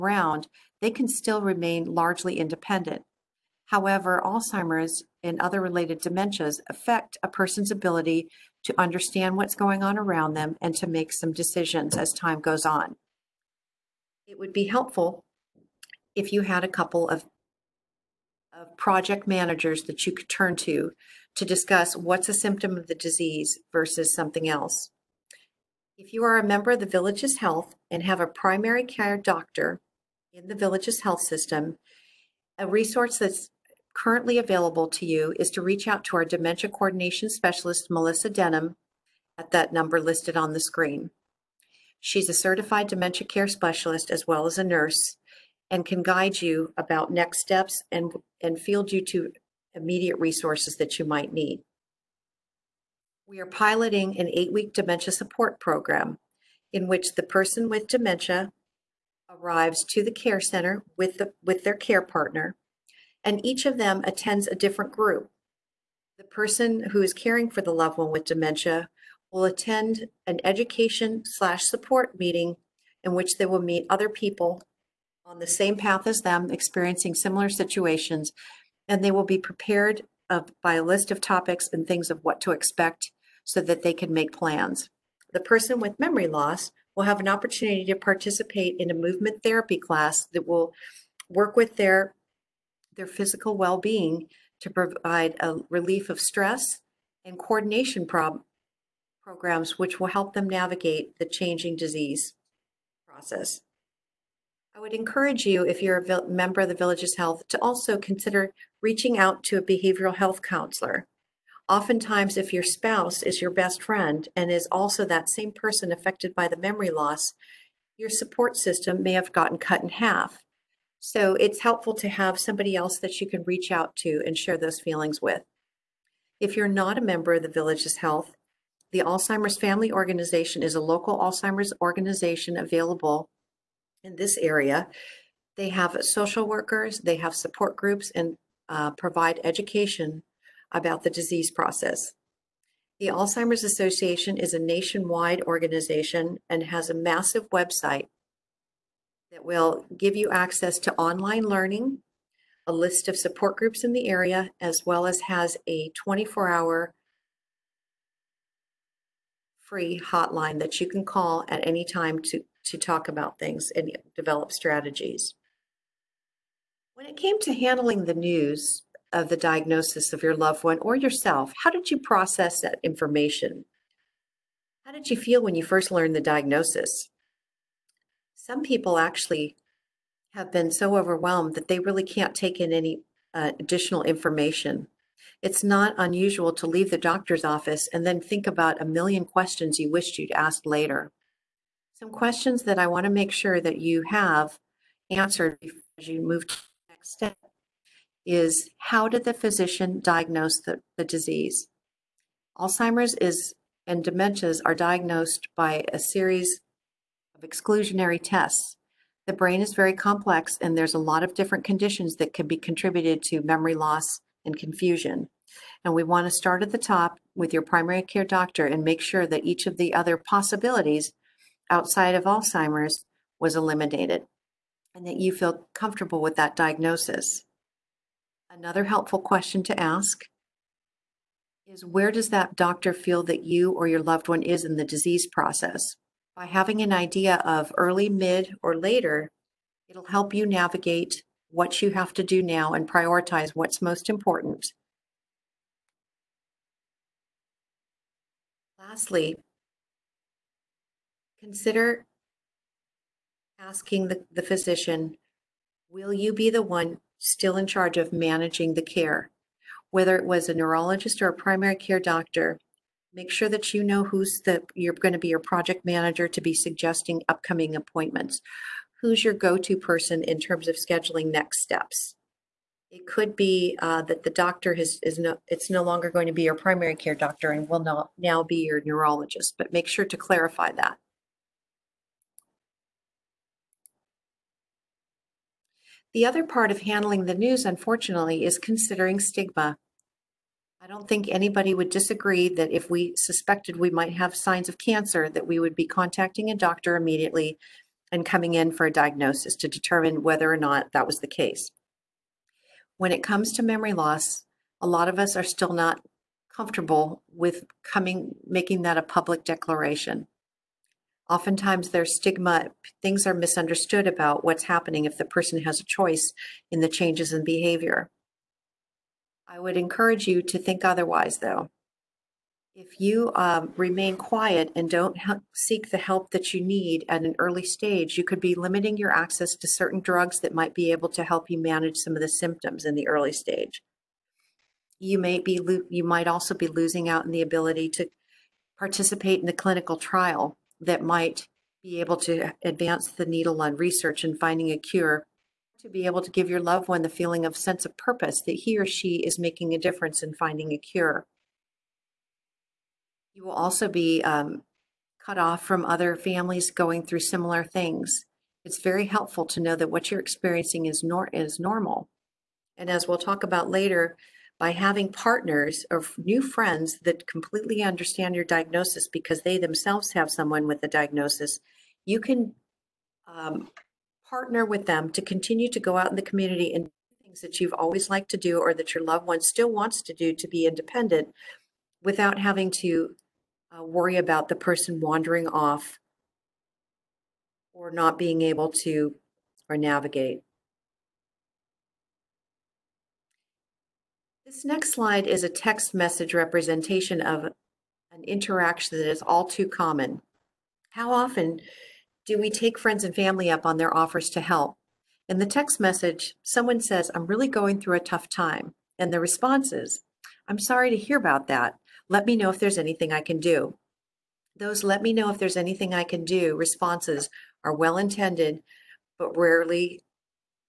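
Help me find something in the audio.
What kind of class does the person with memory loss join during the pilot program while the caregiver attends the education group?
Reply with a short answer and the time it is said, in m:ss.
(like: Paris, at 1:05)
Movement therapy, at 1:28.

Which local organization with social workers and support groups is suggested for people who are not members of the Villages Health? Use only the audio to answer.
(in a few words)
Alzheimer's Family Organization.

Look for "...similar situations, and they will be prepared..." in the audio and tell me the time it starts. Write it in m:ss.
1:17.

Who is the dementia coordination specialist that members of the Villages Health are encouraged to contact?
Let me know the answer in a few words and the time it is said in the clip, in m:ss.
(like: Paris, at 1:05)
Melissa Denham, at 0:37.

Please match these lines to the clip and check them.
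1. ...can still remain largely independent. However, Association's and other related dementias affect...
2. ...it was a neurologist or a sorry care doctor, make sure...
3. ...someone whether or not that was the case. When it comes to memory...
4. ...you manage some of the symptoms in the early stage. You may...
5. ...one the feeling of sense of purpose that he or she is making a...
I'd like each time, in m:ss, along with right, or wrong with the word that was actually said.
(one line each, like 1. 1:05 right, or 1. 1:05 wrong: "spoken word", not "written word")
1. 0:00 wrong: "Alzheimer", not "Association"
2. 4:20 wrong: "primary", not "sorry"
3. 4:59 wrong: "determine", not "someone"
4. 5:31 right
5. 5:46 right.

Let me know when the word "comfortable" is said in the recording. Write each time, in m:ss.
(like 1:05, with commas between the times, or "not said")
3:45, 5:06.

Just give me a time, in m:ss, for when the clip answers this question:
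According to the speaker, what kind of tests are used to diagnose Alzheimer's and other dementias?
3:27.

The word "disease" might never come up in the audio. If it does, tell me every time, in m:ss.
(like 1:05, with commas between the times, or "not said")
0:22, 1:41, 2:21, 3:21, 3:54.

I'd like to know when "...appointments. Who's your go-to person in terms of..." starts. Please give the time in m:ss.
4:27.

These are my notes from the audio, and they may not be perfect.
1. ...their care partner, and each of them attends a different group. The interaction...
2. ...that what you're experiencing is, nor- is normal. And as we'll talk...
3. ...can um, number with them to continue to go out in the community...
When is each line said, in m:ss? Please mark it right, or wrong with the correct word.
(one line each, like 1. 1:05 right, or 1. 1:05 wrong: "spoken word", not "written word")
1. 1:01 wrong: "person", not "interaction"
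2. 5:59 right
3. 6:12 wrong: "partner", not "number".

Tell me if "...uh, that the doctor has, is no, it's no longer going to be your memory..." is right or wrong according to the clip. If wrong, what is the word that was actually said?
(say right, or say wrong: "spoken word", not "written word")
wrong: "primary", not "memory".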